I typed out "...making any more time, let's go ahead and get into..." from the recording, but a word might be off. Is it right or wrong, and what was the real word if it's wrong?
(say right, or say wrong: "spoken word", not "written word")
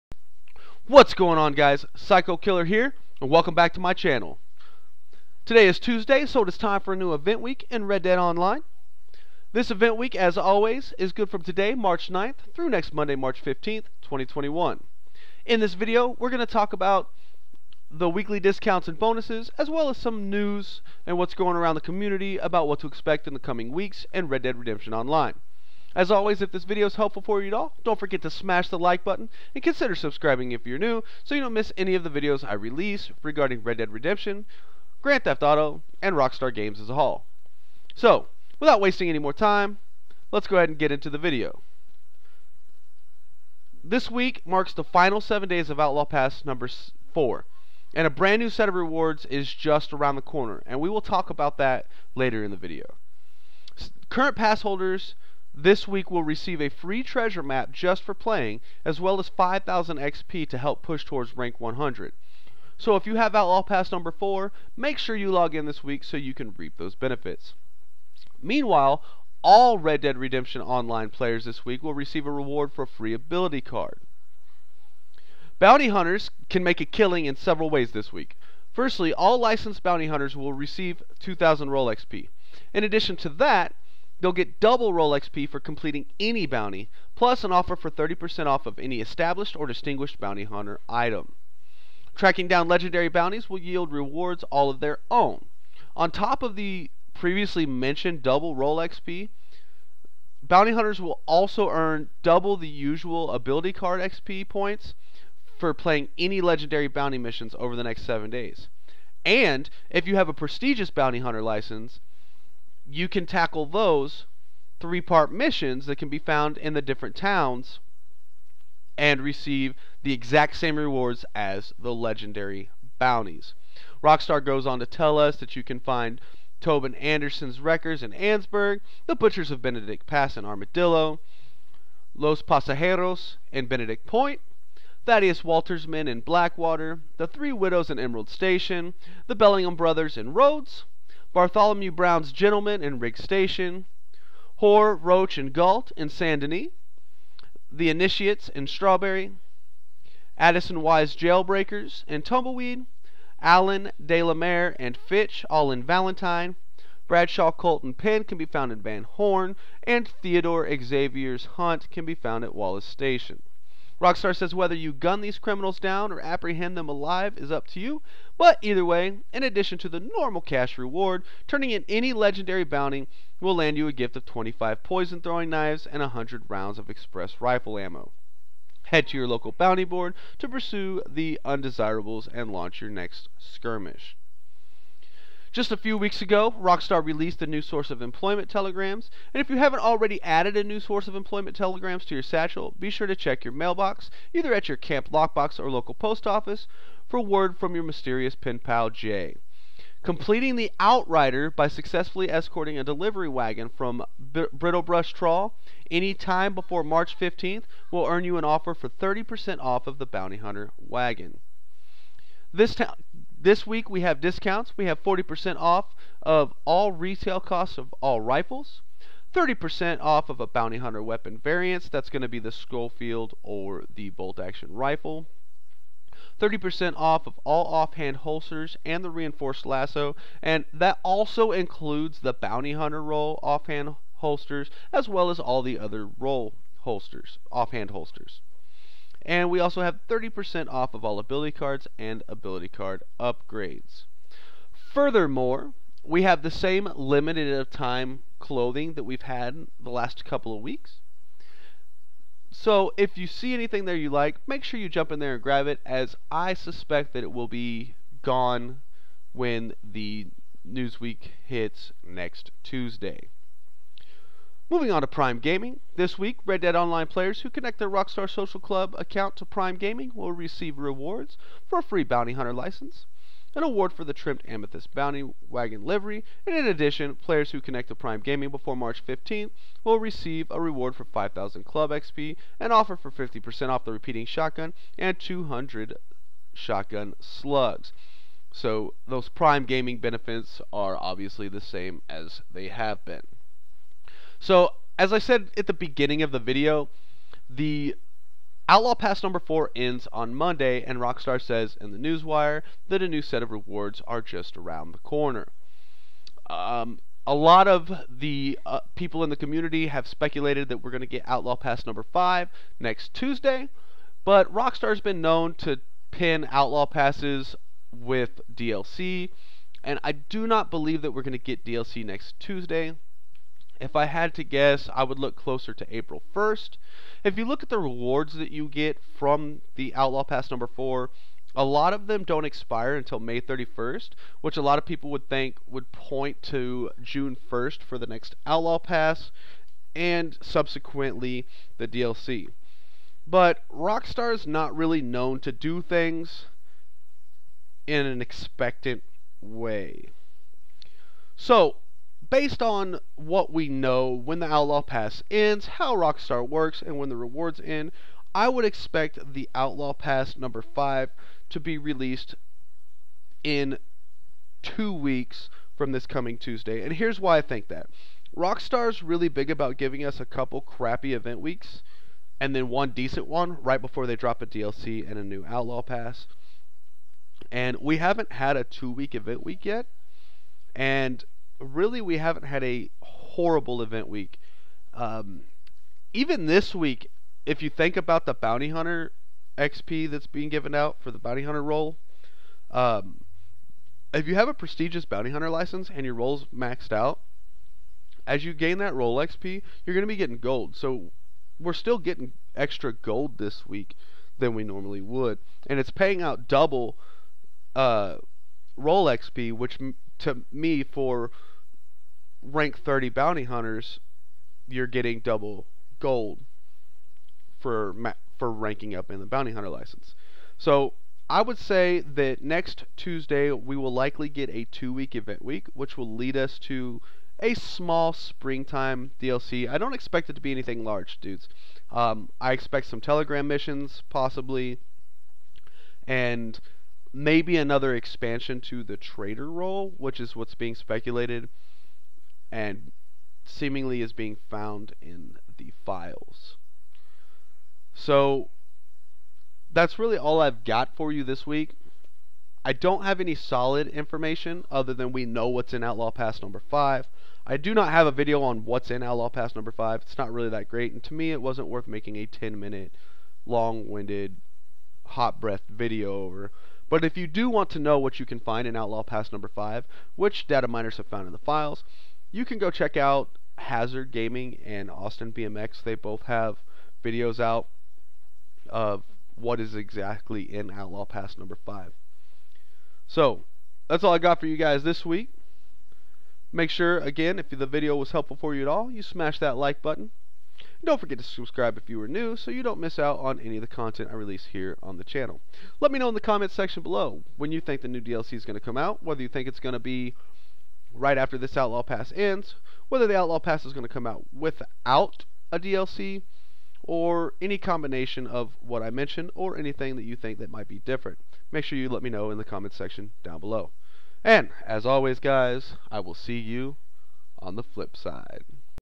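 wrong: "wasting", not "making".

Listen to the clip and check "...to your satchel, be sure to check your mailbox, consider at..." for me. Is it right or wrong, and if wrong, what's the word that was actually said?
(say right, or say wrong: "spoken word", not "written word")
wrong: "either", not "consider".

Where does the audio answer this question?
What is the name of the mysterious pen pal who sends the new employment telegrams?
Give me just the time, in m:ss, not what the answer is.
3:18.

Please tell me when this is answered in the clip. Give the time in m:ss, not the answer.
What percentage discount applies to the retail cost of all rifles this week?
3:35.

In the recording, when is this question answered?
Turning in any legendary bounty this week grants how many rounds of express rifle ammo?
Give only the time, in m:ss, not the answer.
2:56.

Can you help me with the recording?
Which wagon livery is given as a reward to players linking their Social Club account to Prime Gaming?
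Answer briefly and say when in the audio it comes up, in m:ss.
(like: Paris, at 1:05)
trimmed amethyst, at 4:34.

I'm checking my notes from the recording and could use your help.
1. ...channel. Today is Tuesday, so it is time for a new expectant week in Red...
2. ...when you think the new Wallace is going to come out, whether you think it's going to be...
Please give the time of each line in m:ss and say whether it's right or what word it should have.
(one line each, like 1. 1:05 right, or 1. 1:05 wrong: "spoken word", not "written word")
1. 0:03 wrong: "event", not "expectant"
2. 8:17 wrong: "DLC", not "Wallace".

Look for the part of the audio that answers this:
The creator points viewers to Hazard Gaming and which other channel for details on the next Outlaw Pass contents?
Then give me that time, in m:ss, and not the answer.
7:54.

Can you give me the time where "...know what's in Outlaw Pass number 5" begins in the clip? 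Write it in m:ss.
7:35.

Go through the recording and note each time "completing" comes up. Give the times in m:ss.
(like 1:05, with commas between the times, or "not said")
1:25, 3:20.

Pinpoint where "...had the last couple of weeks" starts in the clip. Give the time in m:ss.
4:09.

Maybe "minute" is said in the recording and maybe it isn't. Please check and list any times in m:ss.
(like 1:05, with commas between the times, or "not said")
7:42.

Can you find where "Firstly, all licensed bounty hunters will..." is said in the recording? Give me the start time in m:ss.
1:18.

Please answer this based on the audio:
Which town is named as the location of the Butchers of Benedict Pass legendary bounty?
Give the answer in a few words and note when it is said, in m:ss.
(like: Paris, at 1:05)
Armadillo, at 2:10.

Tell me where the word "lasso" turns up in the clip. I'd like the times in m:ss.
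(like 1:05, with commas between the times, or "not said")
3:49.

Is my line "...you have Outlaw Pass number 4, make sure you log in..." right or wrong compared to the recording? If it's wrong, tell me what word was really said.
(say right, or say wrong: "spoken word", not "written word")
right.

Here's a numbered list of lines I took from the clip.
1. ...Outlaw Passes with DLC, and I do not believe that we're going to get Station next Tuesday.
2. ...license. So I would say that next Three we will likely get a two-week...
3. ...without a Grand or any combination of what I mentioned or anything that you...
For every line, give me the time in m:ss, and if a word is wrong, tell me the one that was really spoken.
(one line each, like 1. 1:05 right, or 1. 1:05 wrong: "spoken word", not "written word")
1. 5:16 wrong: "DLC", not "Station"
2. 6:59 wrong: "Tuesday", not "Three"
3. 8:24 wrong: "DLC", not "Grand".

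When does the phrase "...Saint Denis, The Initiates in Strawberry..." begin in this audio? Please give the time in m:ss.
2:26.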